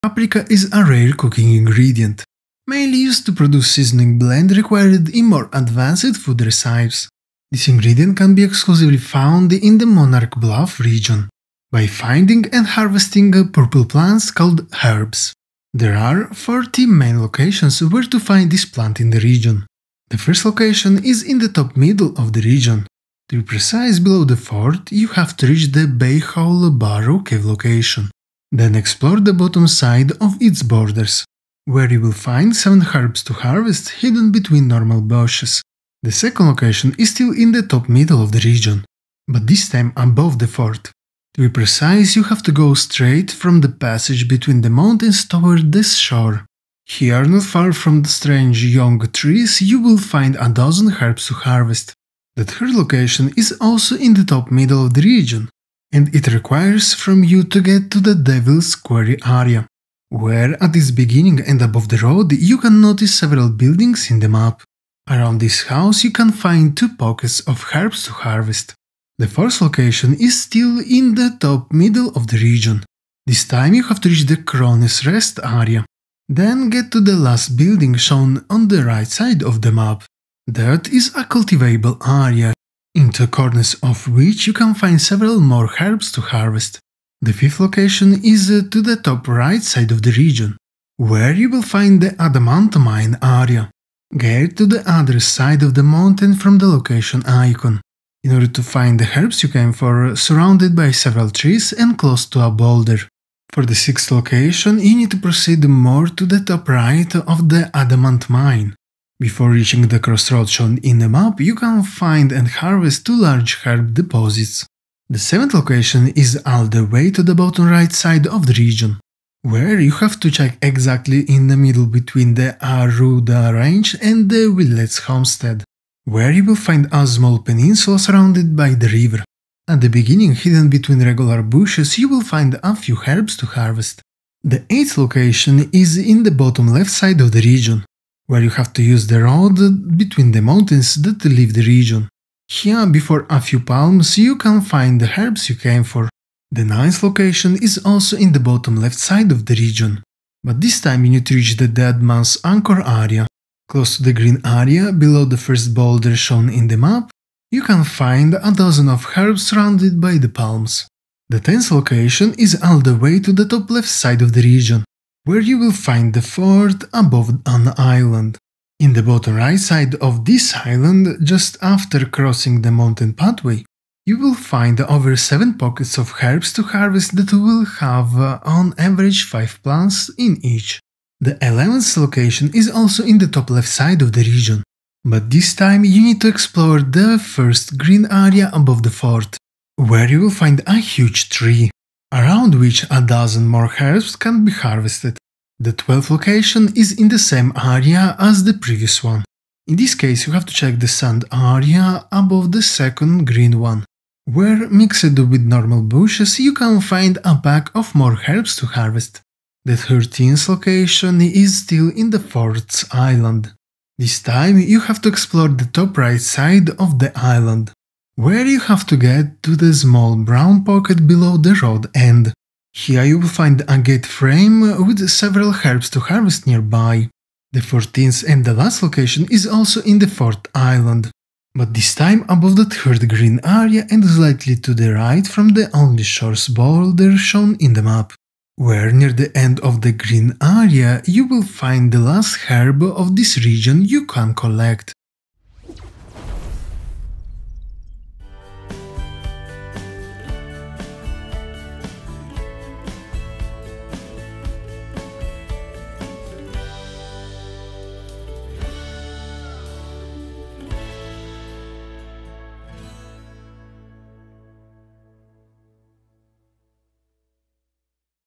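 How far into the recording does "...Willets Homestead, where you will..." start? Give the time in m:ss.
2:04.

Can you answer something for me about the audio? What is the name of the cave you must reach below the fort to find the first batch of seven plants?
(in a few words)
Bayhole Barrow.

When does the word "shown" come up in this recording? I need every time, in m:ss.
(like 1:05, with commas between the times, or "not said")
1:17, 1:50, 2:36, 3:57.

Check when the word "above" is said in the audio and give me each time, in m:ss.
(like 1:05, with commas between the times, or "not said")
0:39, 1:01, 2:46, 3:08, 3:22, 3:52.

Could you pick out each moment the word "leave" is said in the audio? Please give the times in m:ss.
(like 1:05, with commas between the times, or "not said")
2:21.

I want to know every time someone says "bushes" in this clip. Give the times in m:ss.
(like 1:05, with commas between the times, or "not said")
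0:34, 2:11, 3:25.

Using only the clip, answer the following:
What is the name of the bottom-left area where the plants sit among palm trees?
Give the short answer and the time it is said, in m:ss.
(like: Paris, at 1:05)
Dead Man's Anchor, at 2:31.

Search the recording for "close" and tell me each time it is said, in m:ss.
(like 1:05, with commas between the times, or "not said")
1:41, 2:33.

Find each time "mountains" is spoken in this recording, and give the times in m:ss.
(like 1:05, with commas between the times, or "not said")
0:44, 1:35, 2:20, 2:52.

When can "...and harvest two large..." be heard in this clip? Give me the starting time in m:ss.
1:52.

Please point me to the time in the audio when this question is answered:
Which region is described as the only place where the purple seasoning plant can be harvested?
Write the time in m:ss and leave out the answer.
0:09.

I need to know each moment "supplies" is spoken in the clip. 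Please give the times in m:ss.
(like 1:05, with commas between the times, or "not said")
not said.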